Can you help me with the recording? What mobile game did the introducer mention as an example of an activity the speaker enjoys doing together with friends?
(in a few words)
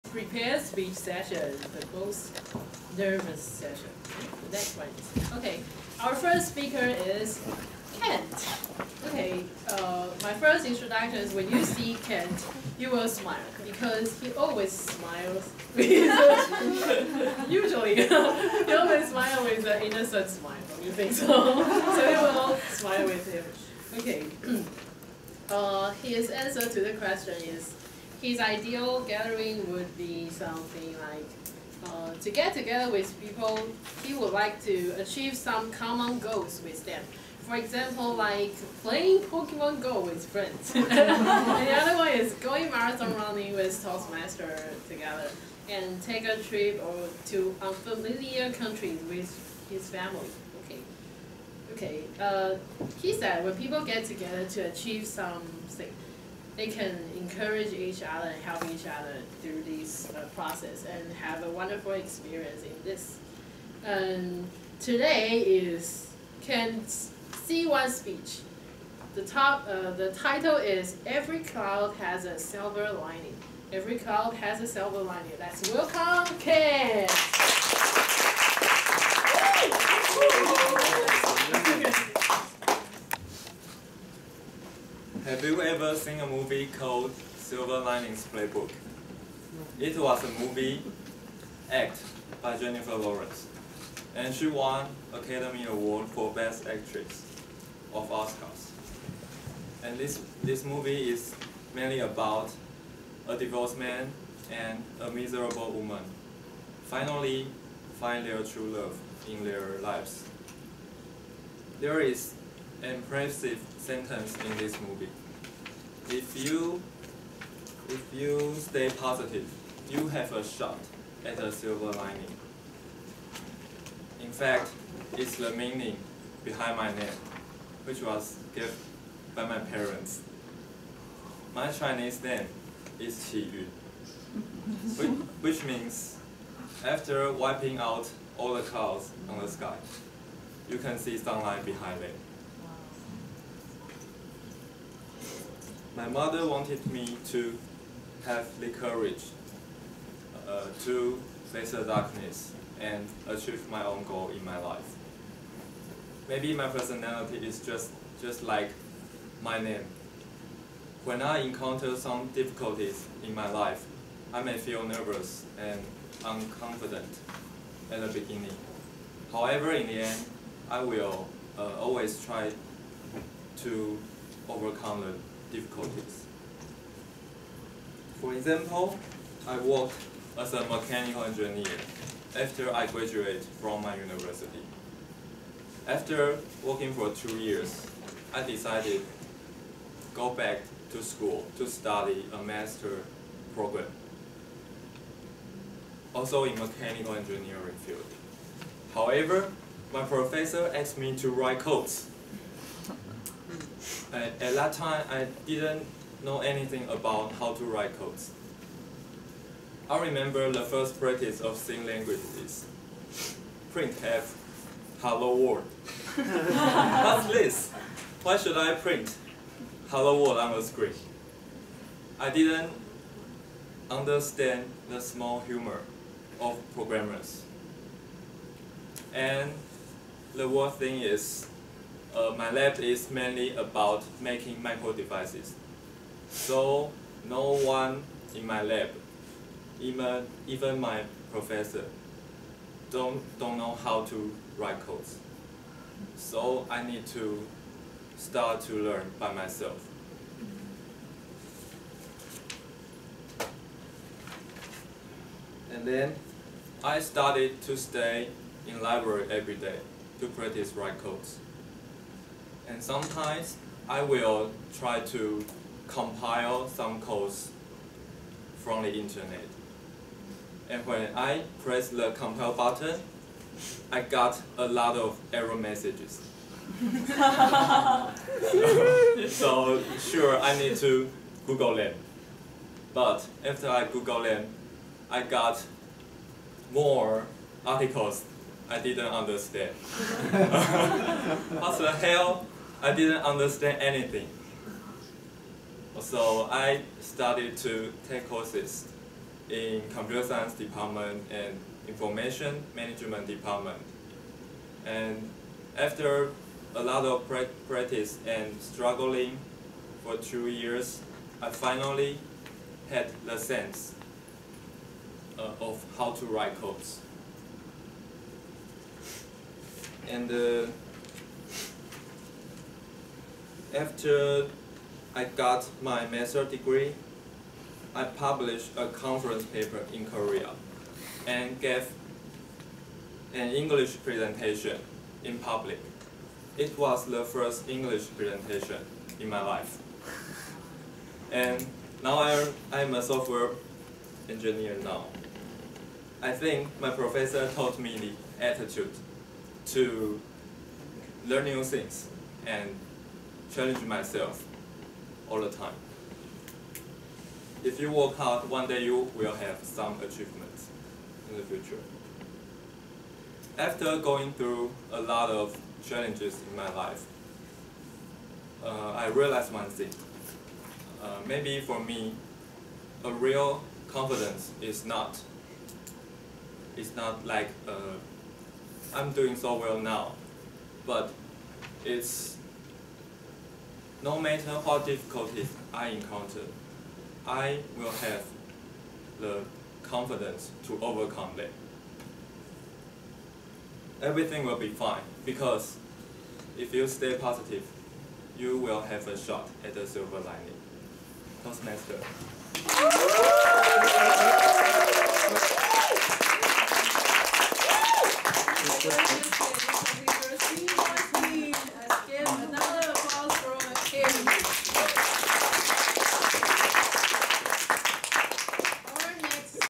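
Pokemon Go.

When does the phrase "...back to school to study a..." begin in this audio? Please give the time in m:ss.
3:10.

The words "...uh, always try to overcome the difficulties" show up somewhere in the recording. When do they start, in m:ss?
2:51.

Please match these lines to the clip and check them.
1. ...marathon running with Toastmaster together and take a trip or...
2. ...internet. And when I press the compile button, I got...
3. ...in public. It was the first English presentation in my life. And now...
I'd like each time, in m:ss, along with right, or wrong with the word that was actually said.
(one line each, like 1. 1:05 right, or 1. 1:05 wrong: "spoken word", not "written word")
1. 0:42 right
2. 4:28 right
3. 5:35 right.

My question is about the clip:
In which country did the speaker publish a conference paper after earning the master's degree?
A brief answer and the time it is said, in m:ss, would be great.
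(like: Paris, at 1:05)
Korea, at 5:30.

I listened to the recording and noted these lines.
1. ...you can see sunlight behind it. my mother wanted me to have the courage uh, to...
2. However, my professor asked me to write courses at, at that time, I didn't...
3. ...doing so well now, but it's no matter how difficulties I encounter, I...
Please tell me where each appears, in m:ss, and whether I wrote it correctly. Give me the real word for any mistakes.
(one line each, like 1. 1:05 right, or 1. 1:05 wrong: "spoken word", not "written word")
1. 2:20 right
2. 3:18 wrong: "codes", not "courses"
3. 6:19 right.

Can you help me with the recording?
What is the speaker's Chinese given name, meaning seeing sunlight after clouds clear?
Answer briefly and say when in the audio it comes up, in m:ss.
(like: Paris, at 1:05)
Qi Yun, at 2:13.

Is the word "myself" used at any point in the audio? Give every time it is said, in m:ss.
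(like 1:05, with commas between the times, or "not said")
4:09, 5:53.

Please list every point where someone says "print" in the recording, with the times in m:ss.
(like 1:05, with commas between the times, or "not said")
3:33, 3:38.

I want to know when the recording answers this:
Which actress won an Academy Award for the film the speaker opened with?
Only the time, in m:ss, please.
1:32.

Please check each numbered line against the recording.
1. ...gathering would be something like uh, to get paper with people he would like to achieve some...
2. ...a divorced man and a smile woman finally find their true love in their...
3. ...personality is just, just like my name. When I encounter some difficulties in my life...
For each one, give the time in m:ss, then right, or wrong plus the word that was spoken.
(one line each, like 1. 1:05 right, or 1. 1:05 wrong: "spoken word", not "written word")
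1. 0:29 wrong: "together", not "paper"
2. 1:43 wrong: "miserable", not "smile"
3. 2:36 right.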